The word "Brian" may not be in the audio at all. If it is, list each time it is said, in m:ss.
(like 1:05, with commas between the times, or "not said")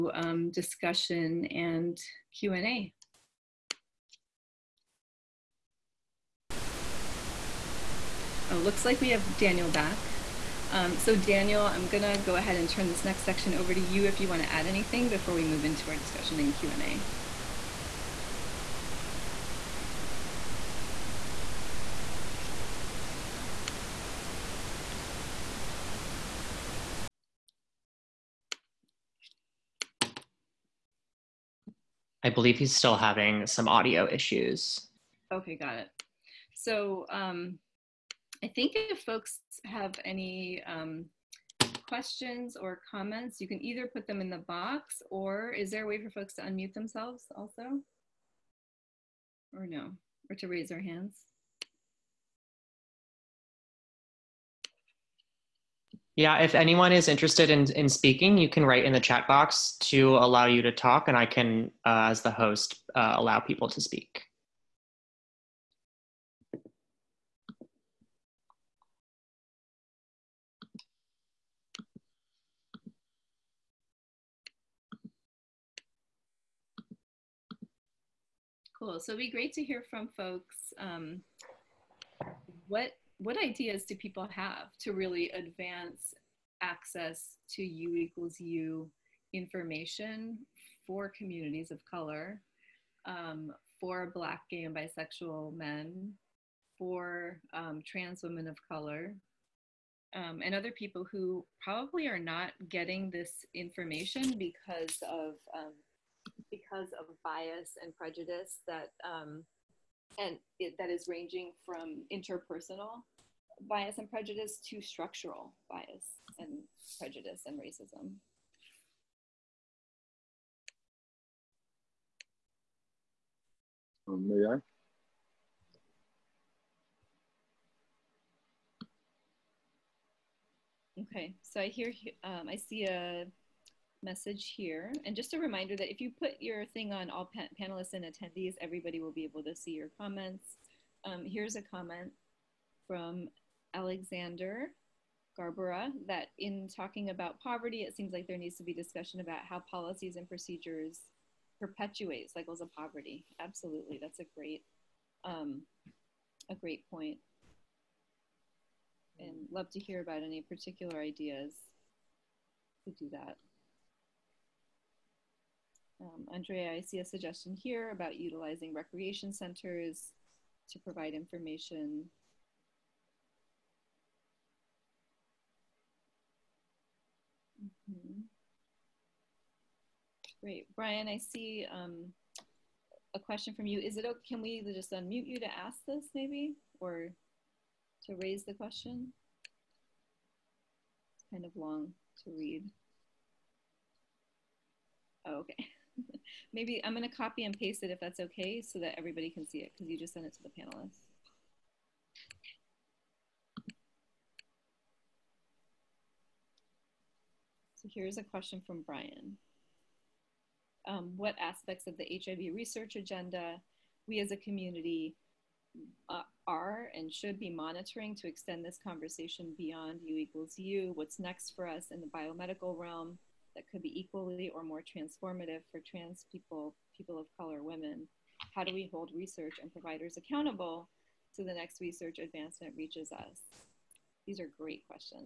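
3:00, 3:28.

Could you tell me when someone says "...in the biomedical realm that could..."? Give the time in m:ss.
3:41.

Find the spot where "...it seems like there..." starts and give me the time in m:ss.
2:27.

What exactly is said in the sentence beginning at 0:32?
I believe he's still having some audio issues.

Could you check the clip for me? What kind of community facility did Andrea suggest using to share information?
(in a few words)
recreation centers.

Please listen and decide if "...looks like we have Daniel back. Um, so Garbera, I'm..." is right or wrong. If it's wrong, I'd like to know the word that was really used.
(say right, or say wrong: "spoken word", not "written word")
wrong: "Daniel", not "Garbera".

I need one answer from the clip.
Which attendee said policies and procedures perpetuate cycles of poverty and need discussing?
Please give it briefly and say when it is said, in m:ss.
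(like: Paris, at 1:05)
Alexander Garbera, at 2:23.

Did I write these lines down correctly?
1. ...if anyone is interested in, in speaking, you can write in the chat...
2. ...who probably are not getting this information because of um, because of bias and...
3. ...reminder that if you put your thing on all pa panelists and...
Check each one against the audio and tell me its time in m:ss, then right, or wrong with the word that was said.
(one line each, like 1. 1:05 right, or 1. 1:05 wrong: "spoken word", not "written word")
1. 0:56 right
2. 1:41 right
3. 2:15 right.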